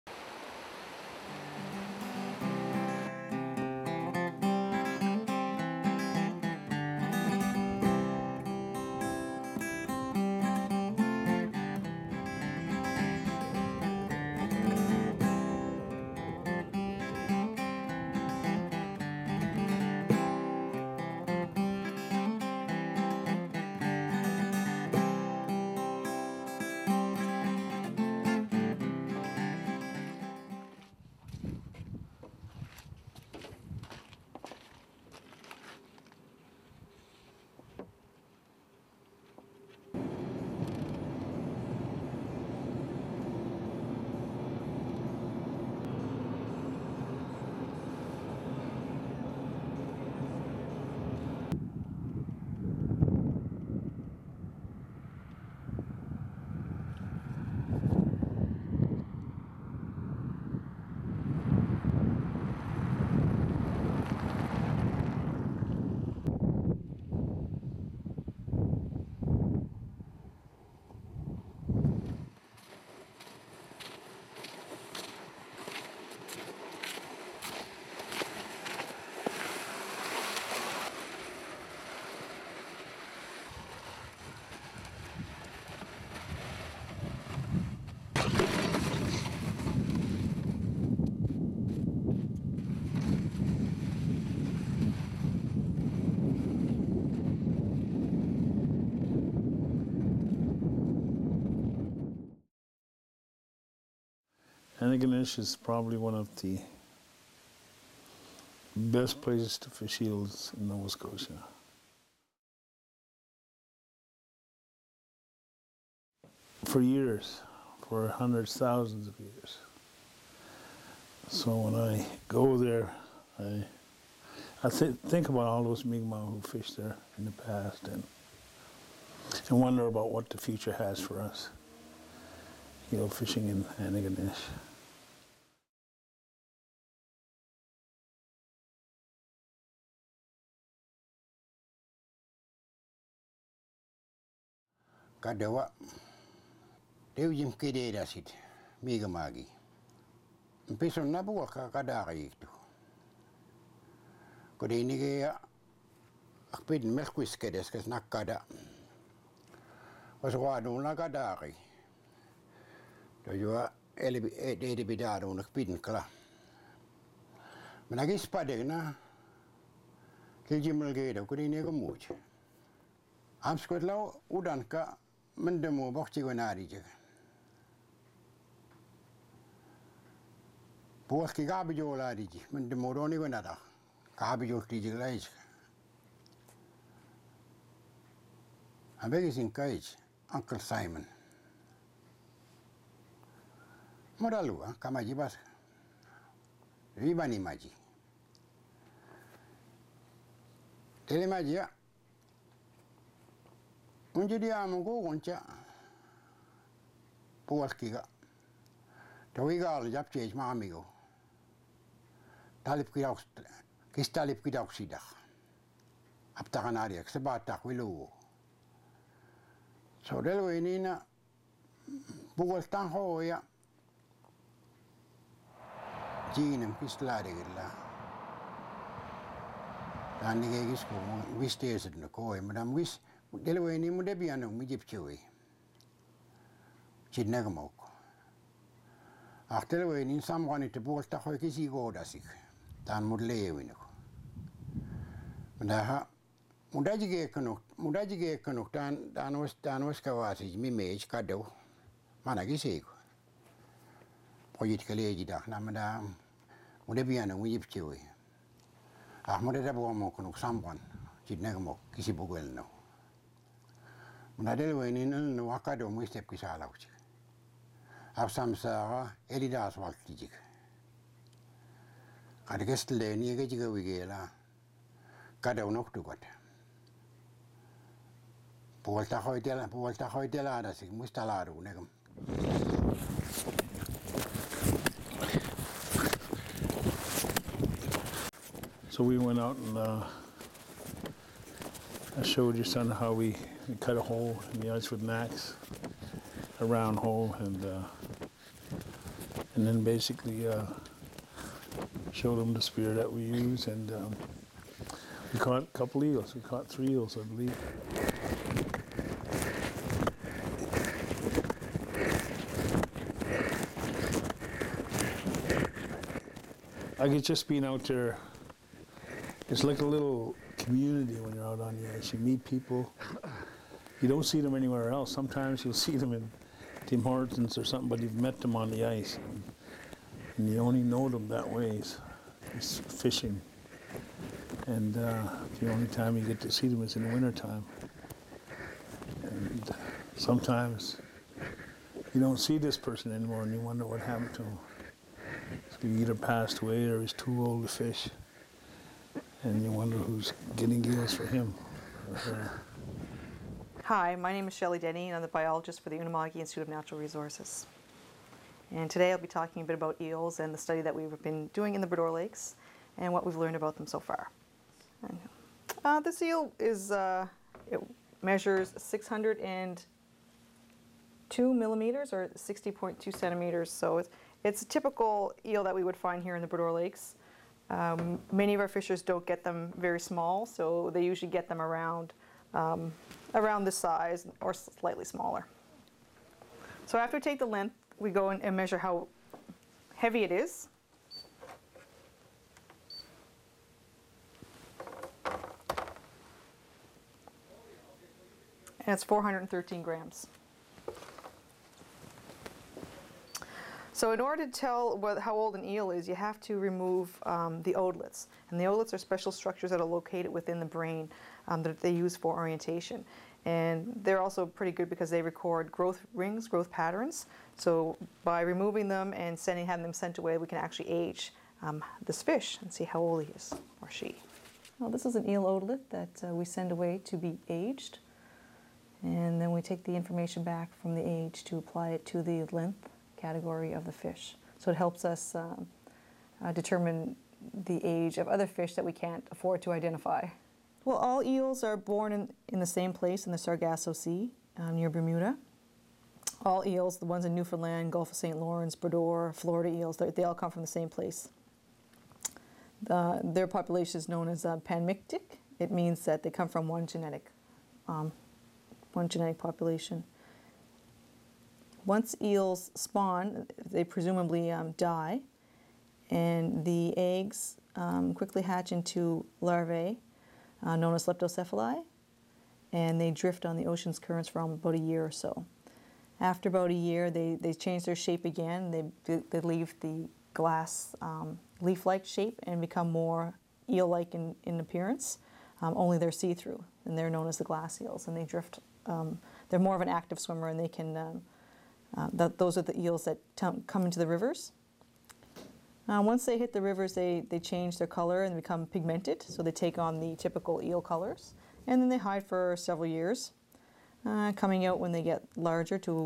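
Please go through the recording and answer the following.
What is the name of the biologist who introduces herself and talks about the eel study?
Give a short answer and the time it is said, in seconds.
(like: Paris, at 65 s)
Shelley Denny, at 354 s.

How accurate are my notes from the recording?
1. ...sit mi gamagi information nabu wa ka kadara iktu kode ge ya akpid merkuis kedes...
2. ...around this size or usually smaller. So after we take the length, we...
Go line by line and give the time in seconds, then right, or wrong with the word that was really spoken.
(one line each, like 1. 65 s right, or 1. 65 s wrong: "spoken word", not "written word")
1. 148 s wrong: "mpeson", not "information"
2. 383 s wrong: "slightly", not "usually".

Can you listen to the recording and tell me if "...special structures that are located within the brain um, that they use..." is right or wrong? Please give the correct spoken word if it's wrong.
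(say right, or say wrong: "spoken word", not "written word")
right.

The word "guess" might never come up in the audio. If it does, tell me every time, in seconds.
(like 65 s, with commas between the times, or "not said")
317 s.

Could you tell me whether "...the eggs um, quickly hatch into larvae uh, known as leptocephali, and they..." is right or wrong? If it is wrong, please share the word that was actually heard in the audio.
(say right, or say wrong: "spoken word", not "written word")
right.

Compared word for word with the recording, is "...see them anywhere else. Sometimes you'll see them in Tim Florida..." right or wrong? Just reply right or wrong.
wrong.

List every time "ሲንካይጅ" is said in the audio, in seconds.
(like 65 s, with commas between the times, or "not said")
189 s.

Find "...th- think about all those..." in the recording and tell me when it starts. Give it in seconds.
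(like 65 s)
124 s.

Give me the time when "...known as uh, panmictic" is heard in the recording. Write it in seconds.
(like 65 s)
454 s.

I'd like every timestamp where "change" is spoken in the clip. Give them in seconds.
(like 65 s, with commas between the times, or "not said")
477 s, 497 s.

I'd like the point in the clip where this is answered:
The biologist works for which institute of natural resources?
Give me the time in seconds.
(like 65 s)
355 s.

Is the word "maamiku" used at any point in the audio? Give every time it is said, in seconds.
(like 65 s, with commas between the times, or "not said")
210 s.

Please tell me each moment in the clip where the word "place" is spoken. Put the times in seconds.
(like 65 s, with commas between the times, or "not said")
109 s, 442 s, 450 s.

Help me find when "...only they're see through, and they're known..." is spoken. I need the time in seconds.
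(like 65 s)
485 s.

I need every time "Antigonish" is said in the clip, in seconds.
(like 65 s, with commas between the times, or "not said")
104 s, 133 s.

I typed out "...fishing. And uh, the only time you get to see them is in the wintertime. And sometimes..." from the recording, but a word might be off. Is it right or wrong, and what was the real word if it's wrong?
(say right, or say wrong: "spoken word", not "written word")
right.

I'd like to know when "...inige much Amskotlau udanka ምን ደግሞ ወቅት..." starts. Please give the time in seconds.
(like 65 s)
171 s.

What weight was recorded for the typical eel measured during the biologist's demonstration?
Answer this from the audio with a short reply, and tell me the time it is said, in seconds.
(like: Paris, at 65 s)
413 grams, at 399 s.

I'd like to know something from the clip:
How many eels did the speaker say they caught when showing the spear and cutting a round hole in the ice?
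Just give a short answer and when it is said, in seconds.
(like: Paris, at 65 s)
3, at 306 s.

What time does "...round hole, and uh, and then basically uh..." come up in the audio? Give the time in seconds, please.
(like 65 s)
296 s.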